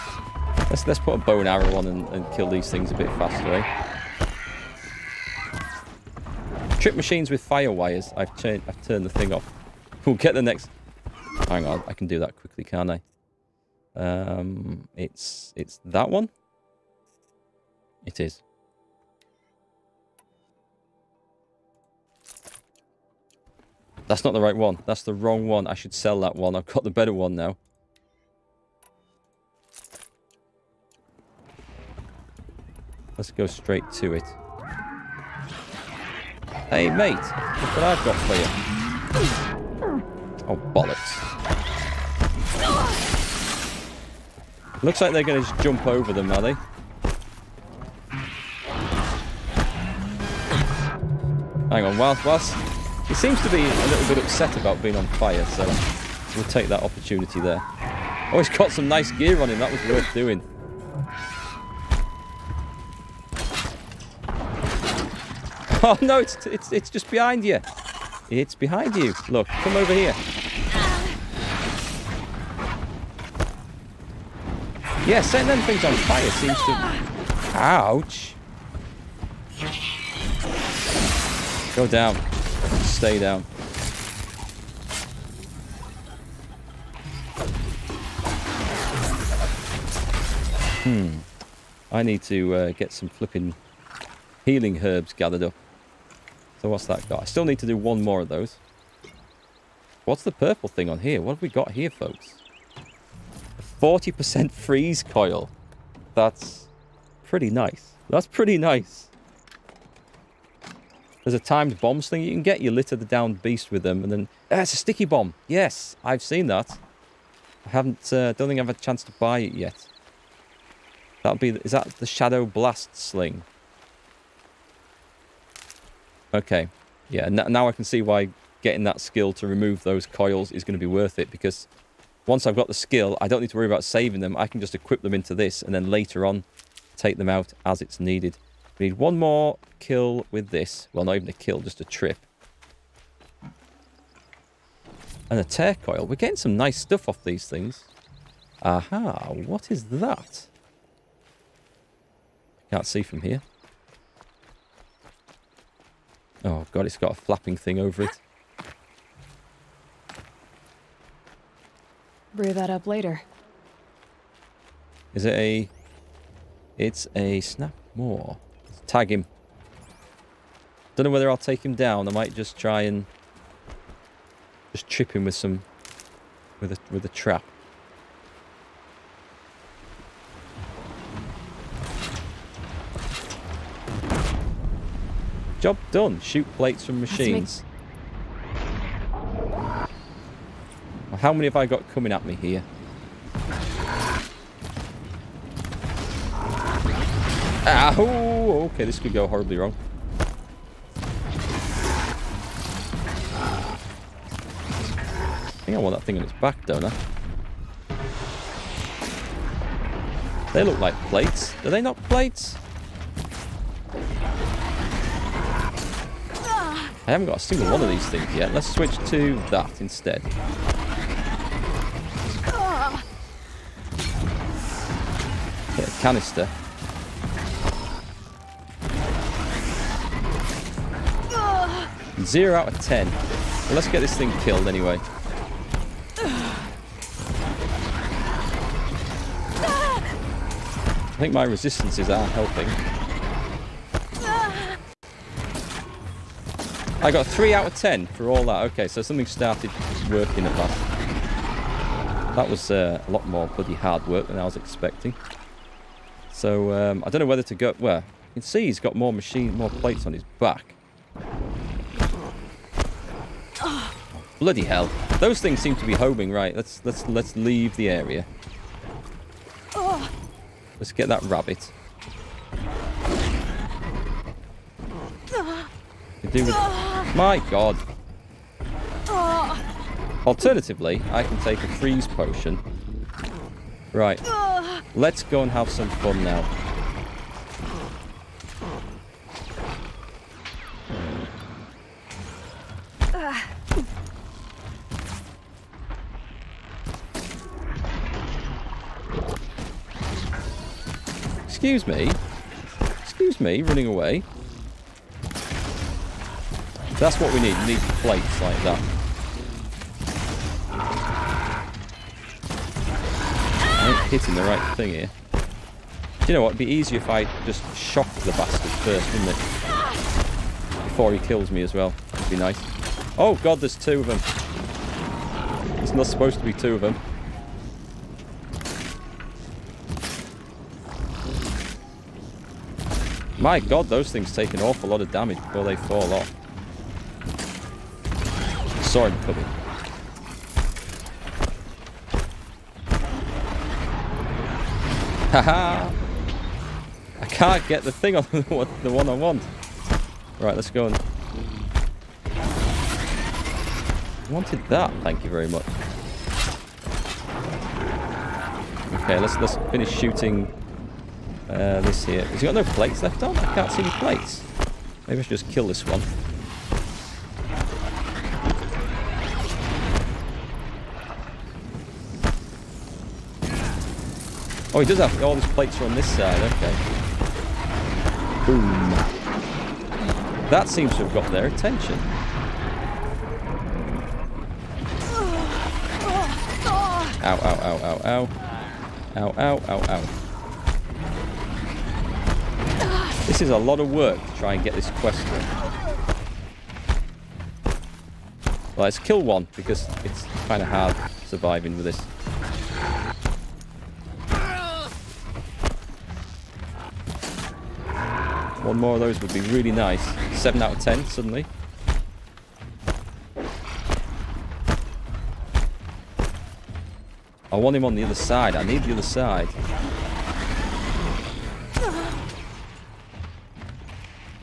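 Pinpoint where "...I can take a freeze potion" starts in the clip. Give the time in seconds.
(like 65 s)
281 s.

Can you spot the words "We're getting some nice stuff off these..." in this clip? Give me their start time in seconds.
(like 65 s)
146 s.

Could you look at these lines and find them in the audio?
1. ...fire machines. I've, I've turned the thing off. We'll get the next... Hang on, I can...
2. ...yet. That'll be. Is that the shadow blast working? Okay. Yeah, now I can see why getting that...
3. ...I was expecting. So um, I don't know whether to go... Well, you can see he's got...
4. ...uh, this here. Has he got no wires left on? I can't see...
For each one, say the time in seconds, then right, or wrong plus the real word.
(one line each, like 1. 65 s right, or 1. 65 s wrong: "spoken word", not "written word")
1. 7 s wrong: "wires", not "machines"
2. 119 s wrong: "sling", not "working"
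3. 254 s right
4. 361 s wrong: "plates", not "wires".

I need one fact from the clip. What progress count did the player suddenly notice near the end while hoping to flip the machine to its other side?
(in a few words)
7 out of 10.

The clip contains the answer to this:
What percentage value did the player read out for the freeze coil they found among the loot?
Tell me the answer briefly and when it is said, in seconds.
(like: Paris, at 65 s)
40%, at 103 s.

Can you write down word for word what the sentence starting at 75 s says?
Yeah, setting them things on fire seems to...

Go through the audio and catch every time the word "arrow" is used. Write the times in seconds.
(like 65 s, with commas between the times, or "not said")
1 s.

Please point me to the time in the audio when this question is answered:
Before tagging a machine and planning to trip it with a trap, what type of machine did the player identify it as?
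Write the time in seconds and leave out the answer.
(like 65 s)
167 s.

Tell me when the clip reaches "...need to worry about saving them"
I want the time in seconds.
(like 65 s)
133 s.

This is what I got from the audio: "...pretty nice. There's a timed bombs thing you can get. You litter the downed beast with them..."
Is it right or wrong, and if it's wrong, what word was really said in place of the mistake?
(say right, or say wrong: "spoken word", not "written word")
right.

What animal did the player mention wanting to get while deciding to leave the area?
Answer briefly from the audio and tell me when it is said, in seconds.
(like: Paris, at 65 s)
rabbit, at 271 s.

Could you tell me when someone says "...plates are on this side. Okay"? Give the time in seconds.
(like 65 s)
375 s.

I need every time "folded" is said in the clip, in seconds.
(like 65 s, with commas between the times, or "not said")
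not said.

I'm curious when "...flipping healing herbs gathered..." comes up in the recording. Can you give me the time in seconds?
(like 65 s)
93 s.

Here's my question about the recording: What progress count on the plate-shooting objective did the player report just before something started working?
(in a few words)
3 out of 10.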